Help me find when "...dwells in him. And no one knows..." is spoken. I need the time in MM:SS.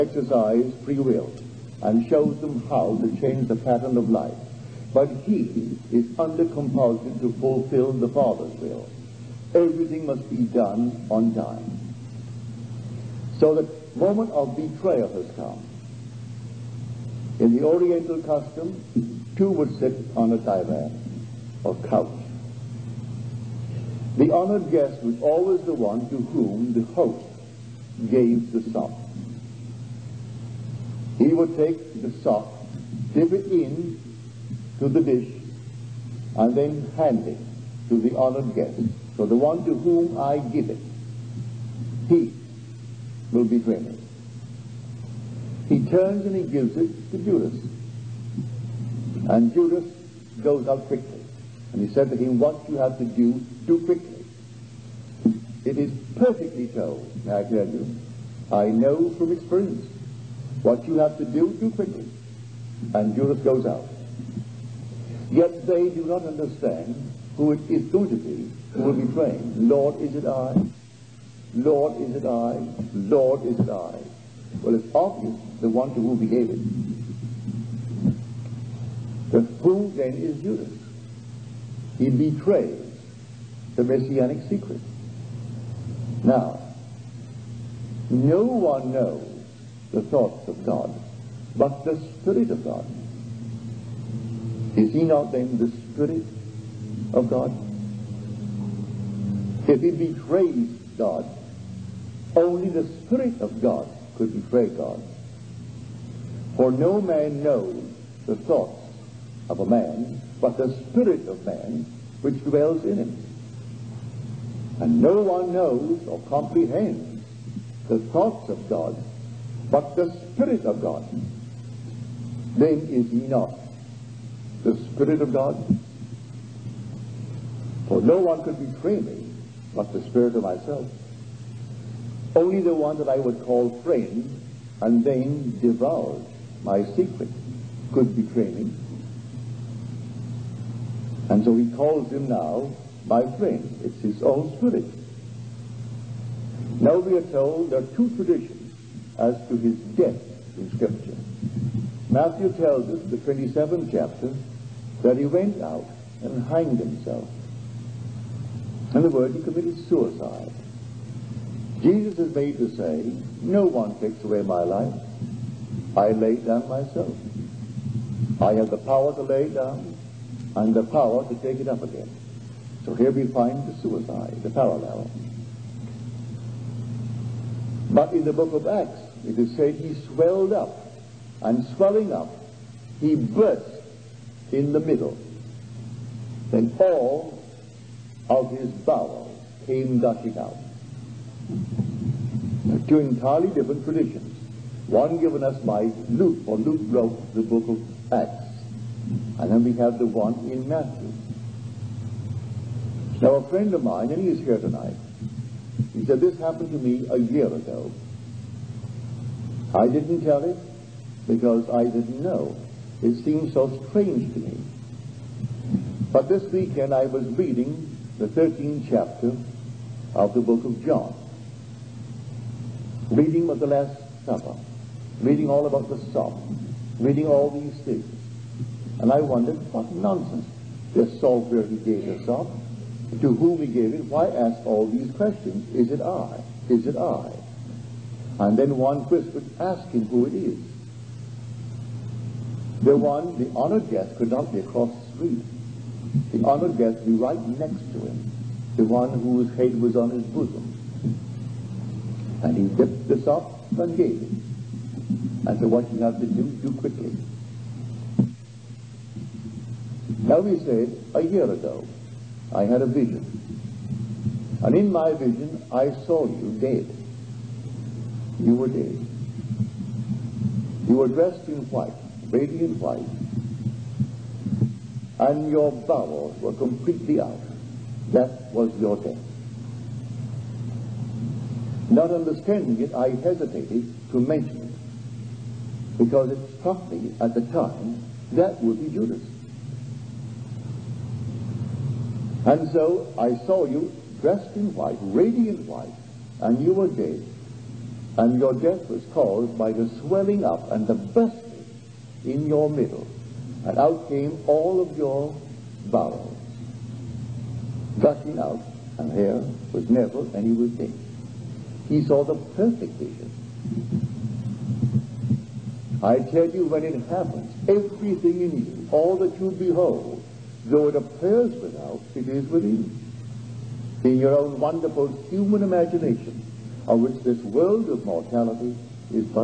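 01:52.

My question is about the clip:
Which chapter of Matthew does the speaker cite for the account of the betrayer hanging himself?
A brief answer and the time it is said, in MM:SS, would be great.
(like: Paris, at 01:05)
27th chapter, at 02:33.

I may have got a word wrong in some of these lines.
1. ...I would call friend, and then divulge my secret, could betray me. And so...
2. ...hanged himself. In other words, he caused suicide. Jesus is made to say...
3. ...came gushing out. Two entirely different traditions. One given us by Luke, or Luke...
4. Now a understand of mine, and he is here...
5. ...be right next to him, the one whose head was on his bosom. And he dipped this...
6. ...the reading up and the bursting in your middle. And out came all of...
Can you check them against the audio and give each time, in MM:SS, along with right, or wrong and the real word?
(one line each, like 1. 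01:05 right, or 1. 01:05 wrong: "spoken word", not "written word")
1. 02:13 right
2. 02:36 wrong: "committed", not "caused"
3. 03:09 right
4. 03:23 wrong: "friend", not "understand"
5. 04:07 right
6. 04:59 wrong: "swelling", not "reading".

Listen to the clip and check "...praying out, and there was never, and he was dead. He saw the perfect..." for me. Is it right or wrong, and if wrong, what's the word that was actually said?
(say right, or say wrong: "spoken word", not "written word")
wrong: "gushing", not "praying".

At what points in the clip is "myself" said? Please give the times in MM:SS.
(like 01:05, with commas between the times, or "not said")
02:10, 02:46.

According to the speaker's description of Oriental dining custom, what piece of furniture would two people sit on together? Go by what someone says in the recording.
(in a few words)
divan or couch.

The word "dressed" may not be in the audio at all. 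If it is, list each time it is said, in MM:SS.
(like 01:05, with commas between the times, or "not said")
04:31, 04:54.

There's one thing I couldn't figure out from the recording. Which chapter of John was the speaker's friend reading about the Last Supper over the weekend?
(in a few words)
13th chapter.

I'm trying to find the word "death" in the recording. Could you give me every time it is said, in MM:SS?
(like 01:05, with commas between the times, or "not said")
02:29, 04:38, 04:58.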